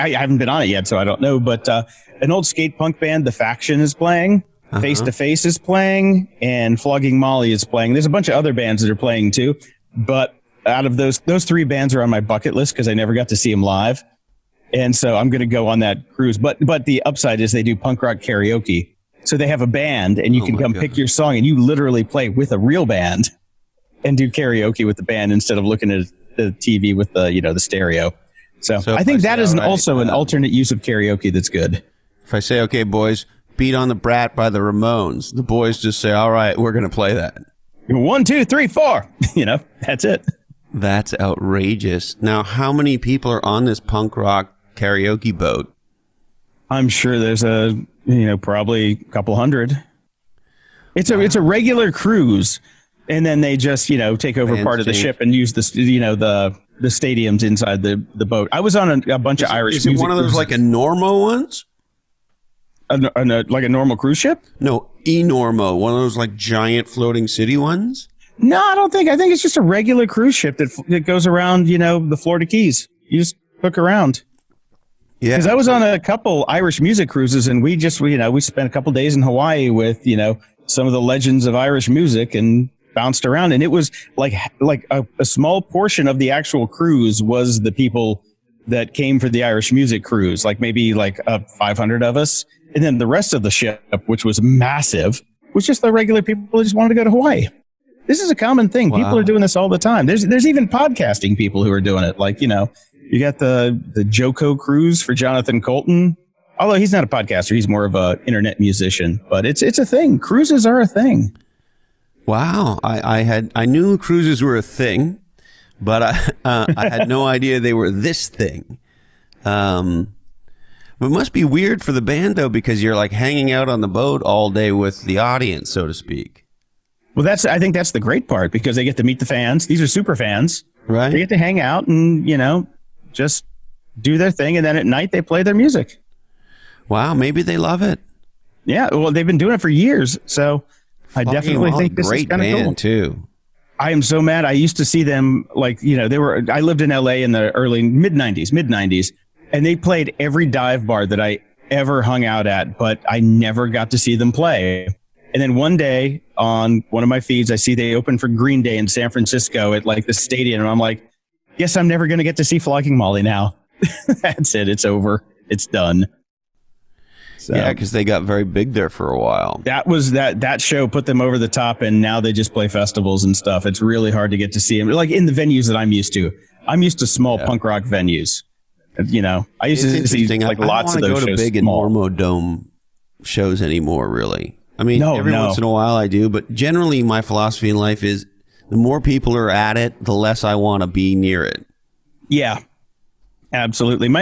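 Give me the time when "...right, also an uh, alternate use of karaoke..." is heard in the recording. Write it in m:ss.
0:29.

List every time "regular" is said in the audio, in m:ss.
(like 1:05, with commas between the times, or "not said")
0:51, 1:09, 1:35.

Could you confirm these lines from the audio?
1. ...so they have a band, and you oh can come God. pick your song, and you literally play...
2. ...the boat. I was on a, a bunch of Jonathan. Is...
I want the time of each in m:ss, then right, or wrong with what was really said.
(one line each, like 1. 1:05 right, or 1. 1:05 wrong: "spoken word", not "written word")
1. 0:19 right
2. 0:58 wrong: "Irish", not "Jonathan".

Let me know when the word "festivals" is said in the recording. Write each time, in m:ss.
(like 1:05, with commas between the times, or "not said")
2:52.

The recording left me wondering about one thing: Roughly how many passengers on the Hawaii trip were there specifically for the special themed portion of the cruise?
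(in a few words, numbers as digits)
500.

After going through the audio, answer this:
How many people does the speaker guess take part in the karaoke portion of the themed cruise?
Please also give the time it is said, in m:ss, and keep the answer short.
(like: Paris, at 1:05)
A couple hundred, at 0:48.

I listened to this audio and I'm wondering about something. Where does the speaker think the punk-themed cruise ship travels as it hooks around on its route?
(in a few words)
The Florida Keys.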